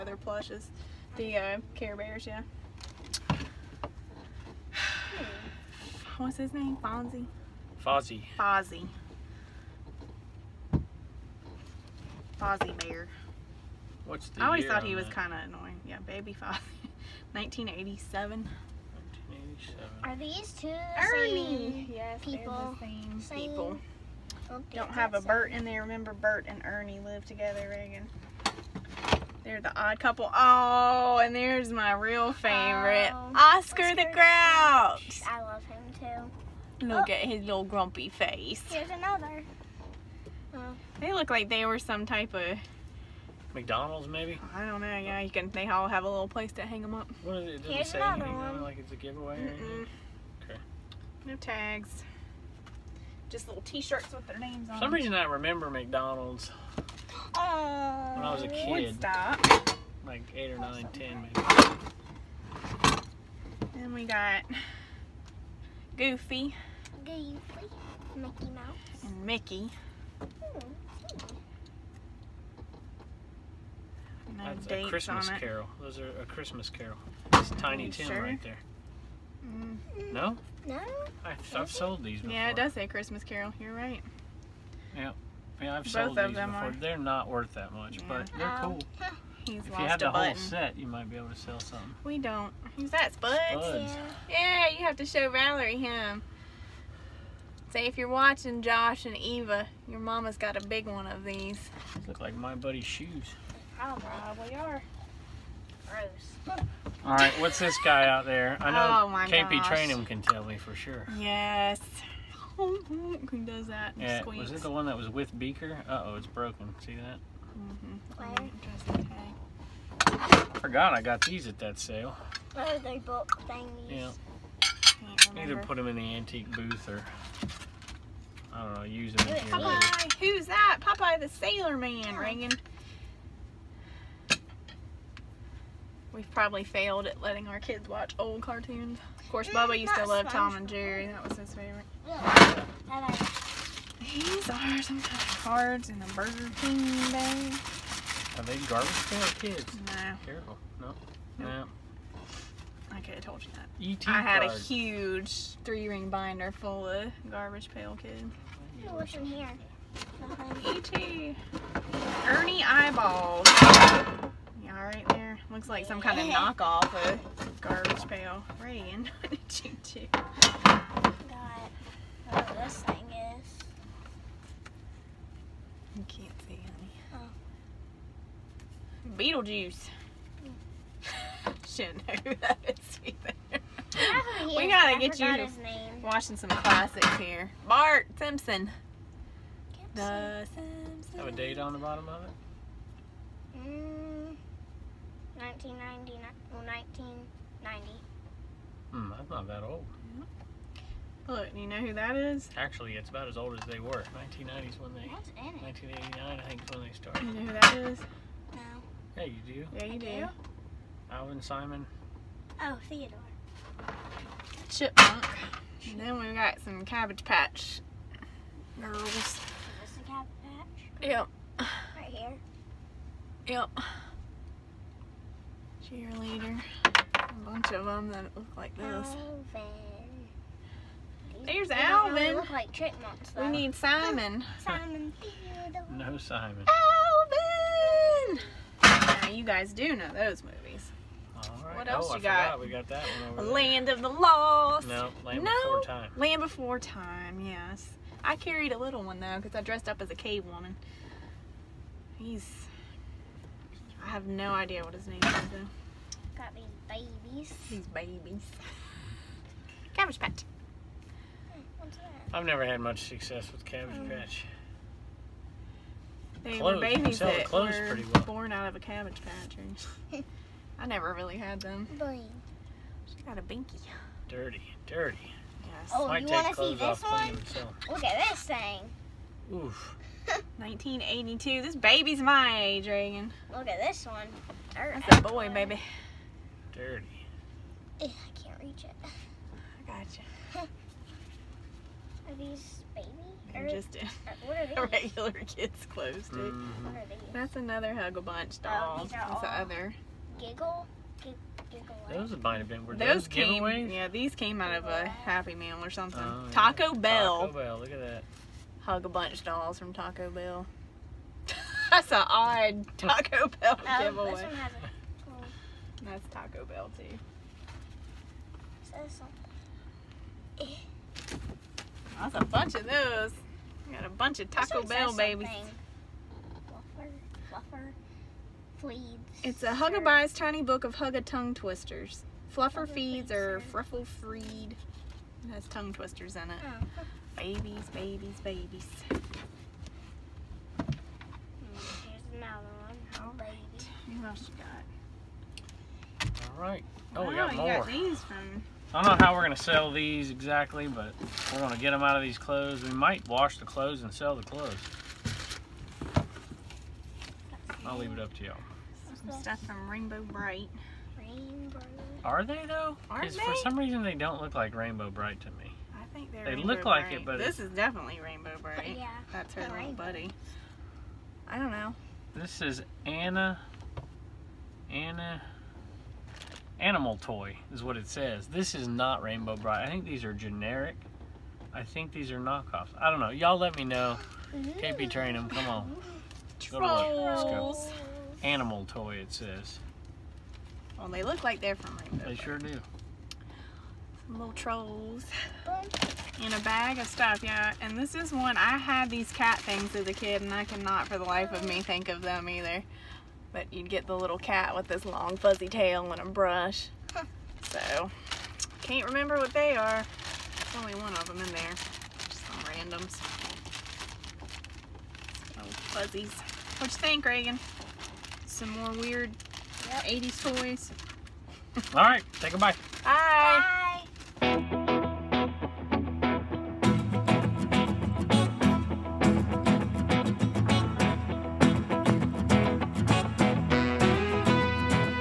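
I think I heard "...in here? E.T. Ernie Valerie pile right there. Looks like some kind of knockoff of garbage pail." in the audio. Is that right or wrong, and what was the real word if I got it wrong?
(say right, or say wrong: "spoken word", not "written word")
wrong: "Eyeballs", not "Valerie".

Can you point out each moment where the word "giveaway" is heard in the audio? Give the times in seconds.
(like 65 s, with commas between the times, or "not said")
48 s, 303 s, 314 s.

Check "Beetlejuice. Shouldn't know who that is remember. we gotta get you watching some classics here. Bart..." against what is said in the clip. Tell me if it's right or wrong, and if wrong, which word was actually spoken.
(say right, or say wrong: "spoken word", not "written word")
wrong: "either", not "remember".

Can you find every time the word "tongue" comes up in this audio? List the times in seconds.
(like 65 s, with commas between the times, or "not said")
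331 s, 335 s.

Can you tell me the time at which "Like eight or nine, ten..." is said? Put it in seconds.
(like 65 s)
60 s.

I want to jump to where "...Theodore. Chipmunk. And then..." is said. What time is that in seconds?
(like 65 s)
212 s.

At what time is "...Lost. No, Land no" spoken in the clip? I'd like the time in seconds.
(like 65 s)
244 s.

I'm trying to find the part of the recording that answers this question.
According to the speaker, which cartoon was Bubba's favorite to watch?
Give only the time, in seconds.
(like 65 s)
140 s.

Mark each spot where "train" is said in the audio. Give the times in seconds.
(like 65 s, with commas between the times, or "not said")
385 s.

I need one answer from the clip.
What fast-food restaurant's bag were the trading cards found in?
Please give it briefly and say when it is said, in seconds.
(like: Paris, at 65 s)
Burger King, at 146 s.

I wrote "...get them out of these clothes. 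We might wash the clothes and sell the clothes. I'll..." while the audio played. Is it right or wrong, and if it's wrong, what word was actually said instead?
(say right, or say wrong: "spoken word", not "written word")
right.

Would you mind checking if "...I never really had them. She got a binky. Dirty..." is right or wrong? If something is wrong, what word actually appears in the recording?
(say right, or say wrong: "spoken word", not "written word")
right.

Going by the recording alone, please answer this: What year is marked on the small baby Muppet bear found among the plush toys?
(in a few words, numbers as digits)
1987.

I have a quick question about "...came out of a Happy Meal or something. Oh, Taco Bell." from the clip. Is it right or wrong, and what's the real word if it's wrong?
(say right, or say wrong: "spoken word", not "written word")
right.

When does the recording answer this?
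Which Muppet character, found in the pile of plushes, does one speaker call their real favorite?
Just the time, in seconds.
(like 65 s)
33 s.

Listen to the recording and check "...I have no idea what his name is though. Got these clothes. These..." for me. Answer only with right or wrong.
wrong.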